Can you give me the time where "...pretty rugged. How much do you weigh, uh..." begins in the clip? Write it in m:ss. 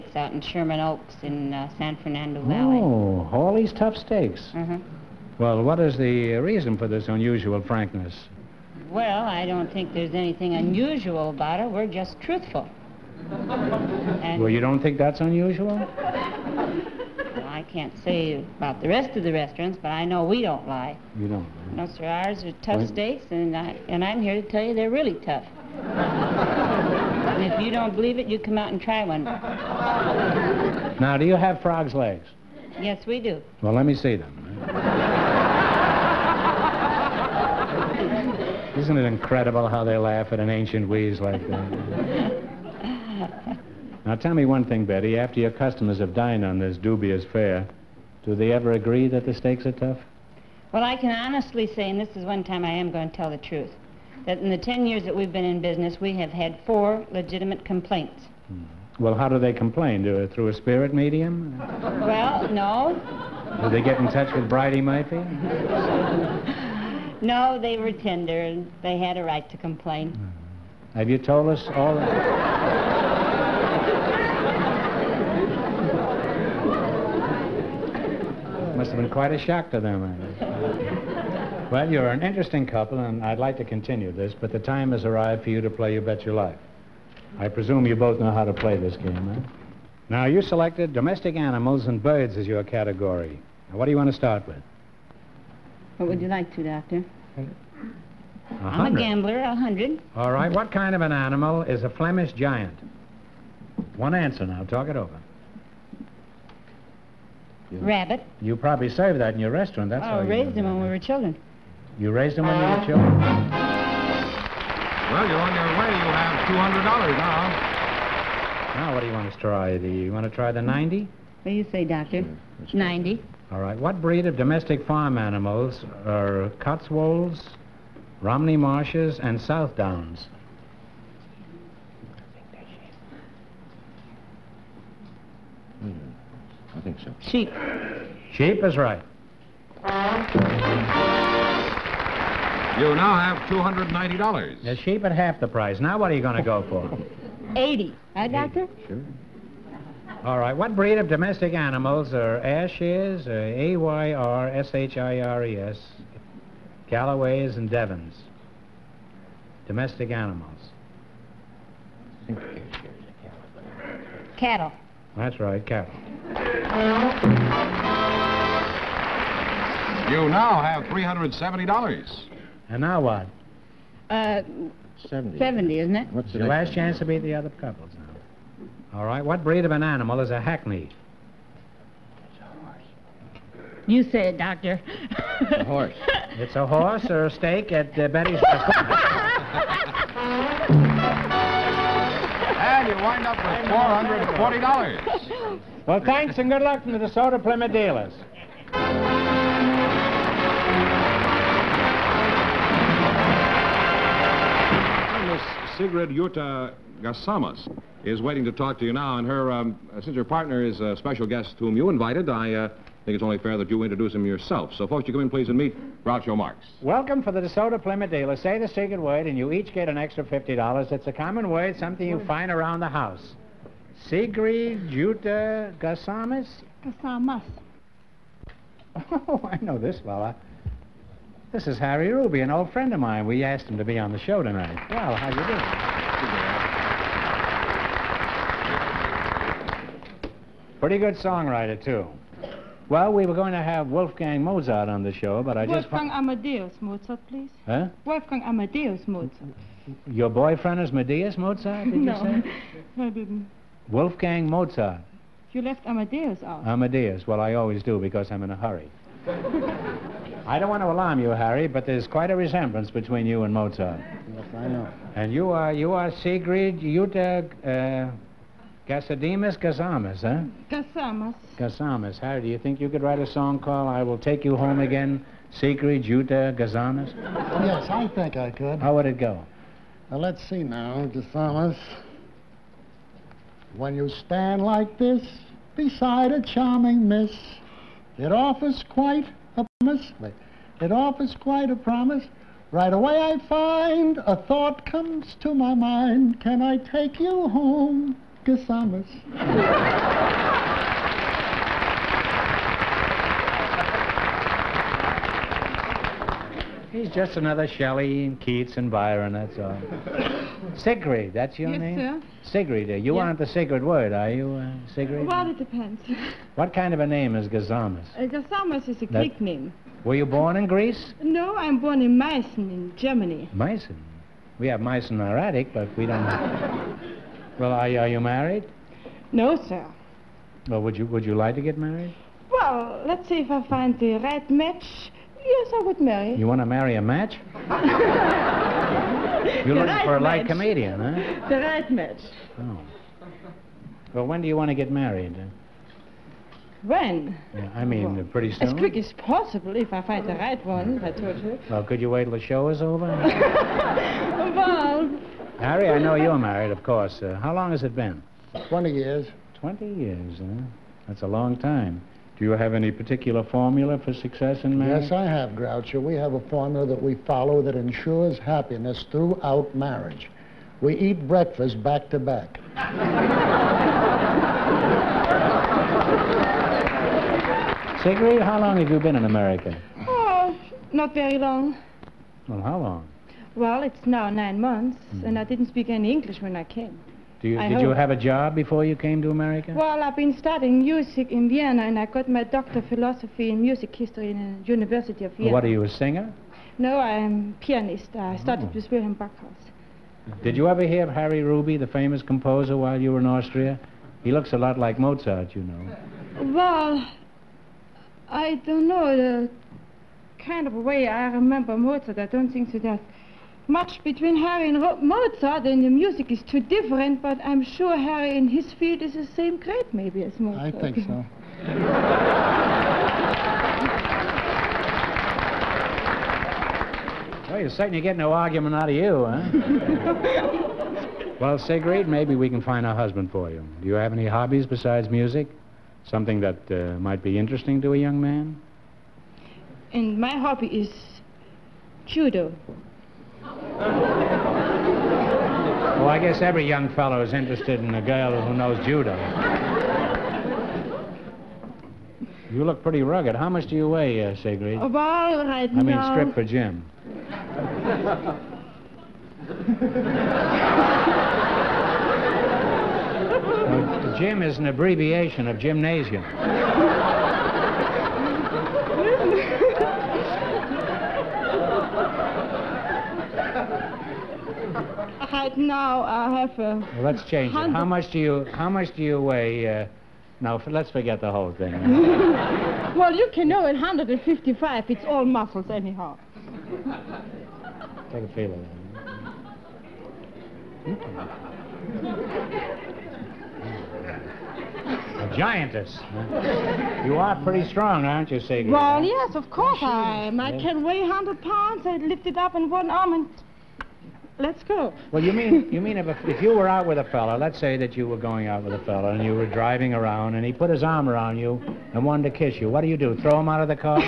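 7:32.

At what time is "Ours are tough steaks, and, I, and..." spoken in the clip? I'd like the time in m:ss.
0:22.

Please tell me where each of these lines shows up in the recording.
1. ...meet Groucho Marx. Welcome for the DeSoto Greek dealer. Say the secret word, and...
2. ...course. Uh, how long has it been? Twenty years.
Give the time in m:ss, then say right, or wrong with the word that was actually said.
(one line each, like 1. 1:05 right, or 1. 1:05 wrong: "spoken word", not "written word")
1. 3:35 wrong: "Plymouth", not "Greek"
2. 5:56 right.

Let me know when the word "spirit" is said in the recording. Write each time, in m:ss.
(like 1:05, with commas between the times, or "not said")
1:00.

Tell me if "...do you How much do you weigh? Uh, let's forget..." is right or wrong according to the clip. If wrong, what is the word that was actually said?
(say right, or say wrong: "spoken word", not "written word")
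right.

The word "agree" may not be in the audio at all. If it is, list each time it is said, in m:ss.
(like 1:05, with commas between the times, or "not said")
0:48.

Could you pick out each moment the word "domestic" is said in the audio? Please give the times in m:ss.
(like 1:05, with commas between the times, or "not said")
1:30, 2:04, 2:31, 2:39.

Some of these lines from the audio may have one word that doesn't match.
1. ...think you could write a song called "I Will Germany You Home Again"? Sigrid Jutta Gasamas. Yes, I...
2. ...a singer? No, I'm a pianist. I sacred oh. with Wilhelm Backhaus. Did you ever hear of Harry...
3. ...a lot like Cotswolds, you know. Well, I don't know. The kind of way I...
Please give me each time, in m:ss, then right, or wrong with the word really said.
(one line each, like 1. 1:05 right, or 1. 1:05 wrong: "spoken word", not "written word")
1. 4:32 wrong: "Take", not "Germany"
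2. 6:35 wrong: "studied", not "sacred"
3. 6:44 wrong: "Mozart", not "Cotswolds".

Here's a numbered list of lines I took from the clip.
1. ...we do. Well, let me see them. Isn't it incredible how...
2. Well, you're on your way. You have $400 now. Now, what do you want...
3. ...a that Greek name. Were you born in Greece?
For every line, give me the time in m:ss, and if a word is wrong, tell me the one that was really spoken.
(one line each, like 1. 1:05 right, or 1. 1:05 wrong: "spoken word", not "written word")
1. 0:33 right
2. 1:55 wrong: "200", not "400"
3. 5:19 right.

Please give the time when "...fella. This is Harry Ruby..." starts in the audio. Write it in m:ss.
3:50.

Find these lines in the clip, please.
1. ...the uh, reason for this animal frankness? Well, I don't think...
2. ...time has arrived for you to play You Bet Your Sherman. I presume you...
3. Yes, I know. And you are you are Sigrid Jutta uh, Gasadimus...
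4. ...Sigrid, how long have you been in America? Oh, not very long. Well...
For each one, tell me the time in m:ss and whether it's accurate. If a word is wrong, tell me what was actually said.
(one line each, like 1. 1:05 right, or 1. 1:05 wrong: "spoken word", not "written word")
1. 0:05 wrong: "unusual", not "animal"
2. 1:24 wrong: "Life", not "Sherman"
3. 4:24 right
4. 6:18 right.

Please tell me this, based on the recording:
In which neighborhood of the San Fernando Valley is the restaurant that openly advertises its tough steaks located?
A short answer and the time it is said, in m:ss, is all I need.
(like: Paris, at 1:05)
Sherman Oaks, at 0:00.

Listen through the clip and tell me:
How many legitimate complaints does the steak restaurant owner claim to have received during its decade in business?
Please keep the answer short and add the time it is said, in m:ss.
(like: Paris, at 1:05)
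4, at 0:56.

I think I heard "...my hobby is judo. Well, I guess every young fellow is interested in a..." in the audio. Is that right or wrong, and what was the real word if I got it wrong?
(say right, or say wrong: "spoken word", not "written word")
right.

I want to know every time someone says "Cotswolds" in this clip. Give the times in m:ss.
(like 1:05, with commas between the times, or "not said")
2:06.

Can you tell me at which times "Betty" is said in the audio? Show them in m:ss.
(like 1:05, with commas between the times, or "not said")
0:44, 3:08.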